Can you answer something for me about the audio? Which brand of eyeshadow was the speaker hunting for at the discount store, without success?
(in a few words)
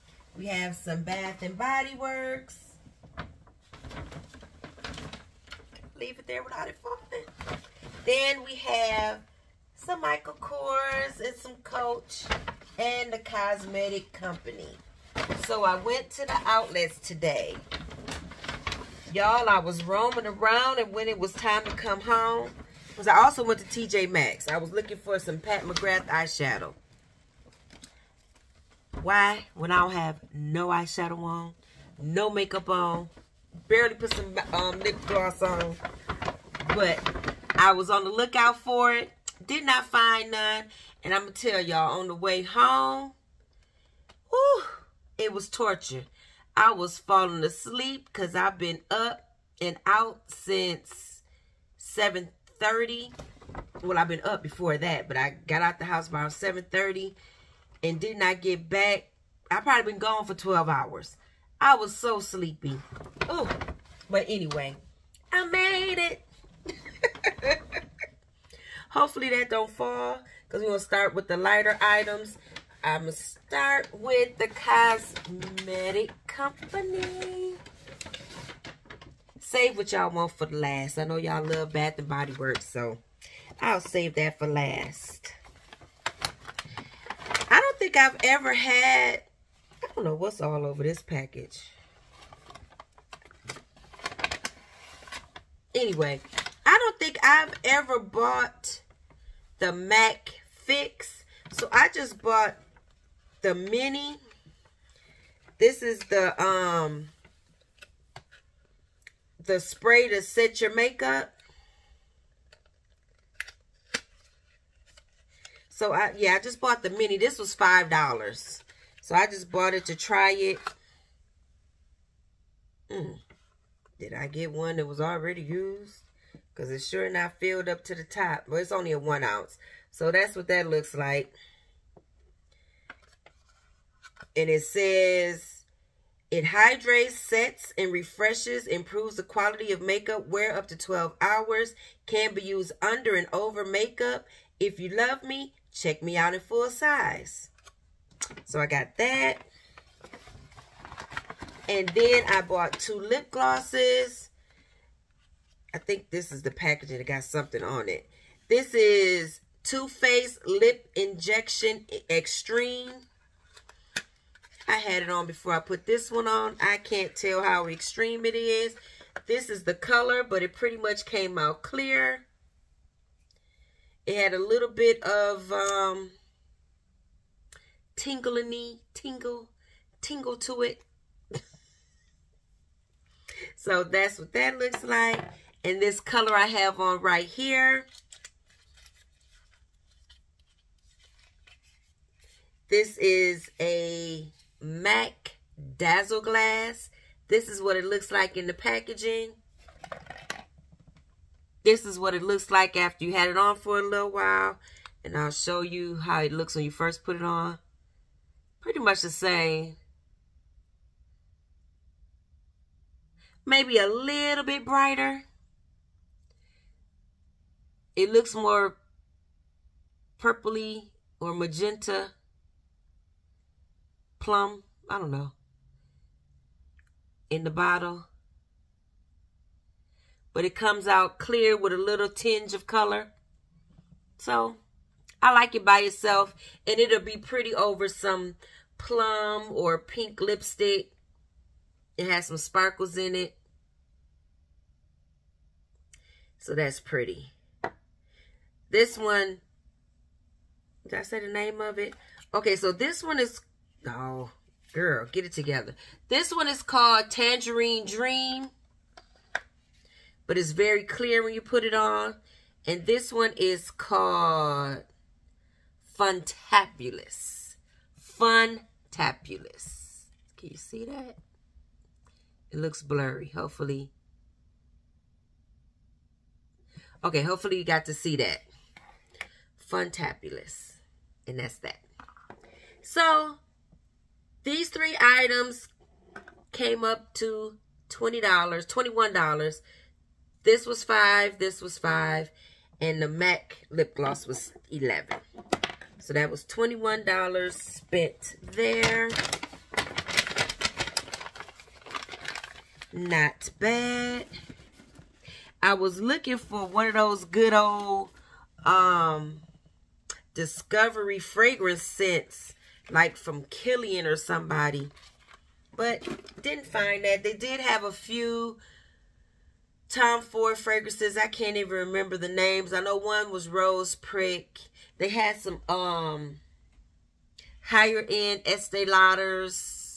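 Pat McGrath.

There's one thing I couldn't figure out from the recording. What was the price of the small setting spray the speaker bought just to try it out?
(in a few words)
$5.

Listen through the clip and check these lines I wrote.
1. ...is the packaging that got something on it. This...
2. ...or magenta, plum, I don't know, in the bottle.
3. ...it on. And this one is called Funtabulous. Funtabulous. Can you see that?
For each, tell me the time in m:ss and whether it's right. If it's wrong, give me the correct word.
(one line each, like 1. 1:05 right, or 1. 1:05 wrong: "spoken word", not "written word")
1. 2:36 right
2. 3:41 right
3. 4:21 right.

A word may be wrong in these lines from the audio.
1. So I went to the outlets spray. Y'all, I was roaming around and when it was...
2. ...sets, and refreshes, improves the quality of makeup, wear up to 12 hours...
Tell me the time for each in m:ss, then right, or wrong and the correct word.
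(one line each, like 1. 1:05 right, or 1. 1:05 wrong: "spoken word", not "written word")
1. 0:15 wrong: "today", not "spray"
2. 2:17 right.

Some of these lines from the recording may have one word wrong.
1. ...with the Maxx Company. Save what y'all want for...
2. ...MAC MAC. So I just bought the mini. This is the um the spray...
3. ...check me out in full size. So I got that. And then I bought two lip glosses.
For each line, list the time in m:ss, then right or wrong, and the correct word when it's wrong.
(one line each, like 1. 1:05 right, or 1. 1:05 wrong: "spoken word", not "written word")
1. 1:13 wrong: "Cosmetic", not "Maxx"
2. 1:39 wrong: "Fix", not "MAC"
3. 2:25 right.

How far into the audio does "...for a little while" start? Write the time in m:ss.
3:23.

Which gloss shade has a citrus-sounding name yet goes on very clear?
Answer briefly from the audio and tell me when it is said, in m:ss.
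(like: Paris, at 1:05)
Tangerine Dream, at 4:17.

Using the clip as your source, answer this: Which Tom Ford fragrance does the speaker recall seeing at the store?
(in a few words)
Rose Prick.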